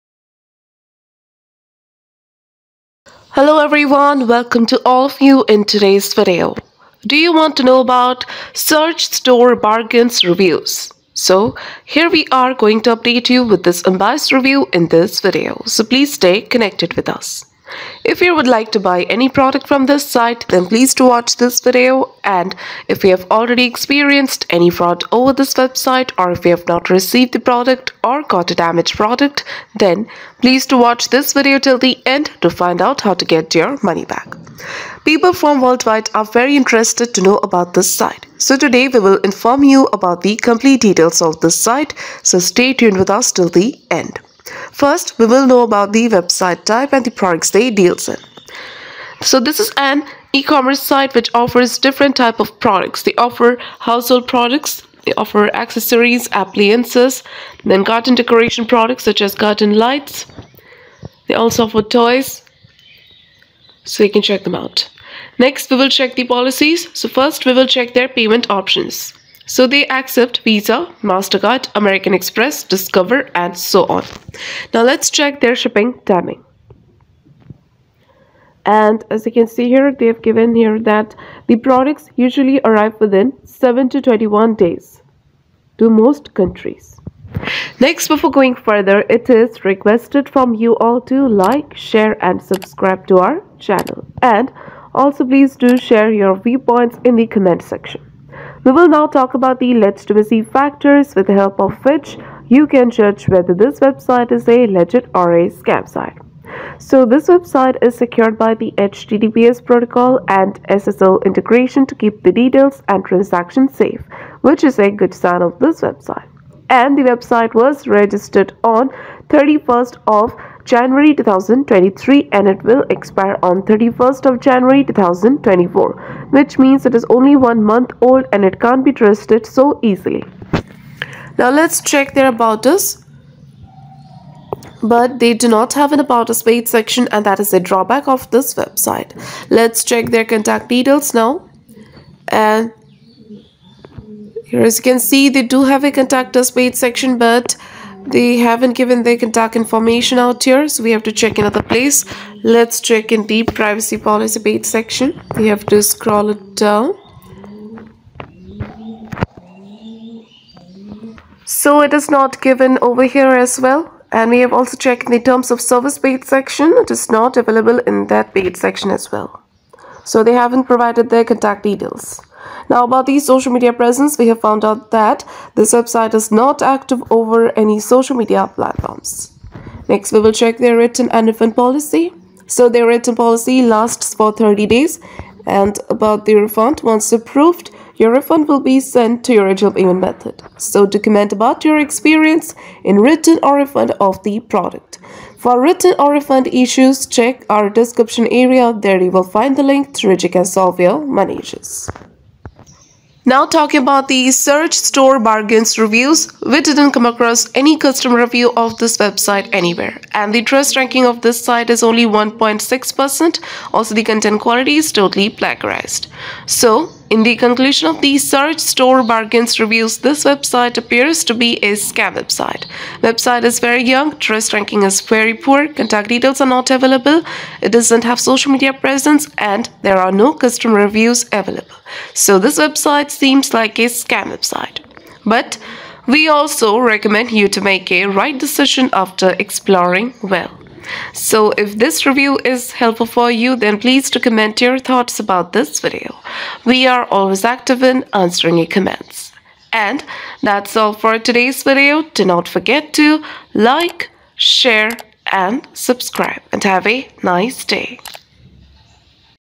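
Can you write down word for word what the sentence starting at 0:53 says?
They offer household products, they offer accessories, appliances, then garden decoration products such as garden lights.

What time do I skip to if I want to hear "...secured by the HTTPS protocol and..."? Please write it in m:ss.
1:47.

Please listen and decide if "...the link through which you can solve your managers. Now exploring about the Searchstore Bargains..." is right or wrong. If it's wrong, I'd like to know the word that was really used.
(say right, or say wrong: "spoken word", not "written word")
wrong: "talking", not "exploring".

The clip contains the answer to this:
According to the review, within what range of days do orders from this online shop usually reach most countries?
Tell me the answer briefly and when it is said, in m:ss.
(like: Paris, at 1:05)
7 to 21 days, at 1:23.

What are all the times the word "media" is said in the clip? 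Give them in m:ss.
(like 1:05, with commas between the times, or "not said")
2:53, 2:58, 3:48.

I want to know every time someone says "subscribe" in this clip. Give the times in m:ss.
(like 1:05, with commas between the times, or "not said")
1:32, 4:15.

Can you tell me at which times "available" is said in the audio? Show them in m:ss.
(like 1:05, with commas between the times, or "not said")
2:47, 3:46, 3:51.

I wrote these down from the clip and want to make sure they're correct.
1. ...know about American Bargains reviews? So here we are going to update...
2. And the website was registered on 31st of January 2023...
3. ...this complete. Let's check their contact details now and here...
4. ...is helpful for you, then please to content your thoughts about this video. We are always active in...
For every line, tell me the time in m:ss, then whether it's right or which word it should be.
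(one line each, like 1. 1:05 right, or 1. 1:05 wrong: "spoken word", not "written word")
1. 0:07 wrong: "Searchstore", not "American"
2. 1:56 right
3. 2:18 wrong: "website", not "complete"
4. 4:02 wrong: "comment", not "content".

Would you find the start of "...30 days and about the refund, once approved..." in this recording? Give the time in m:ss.
3:04.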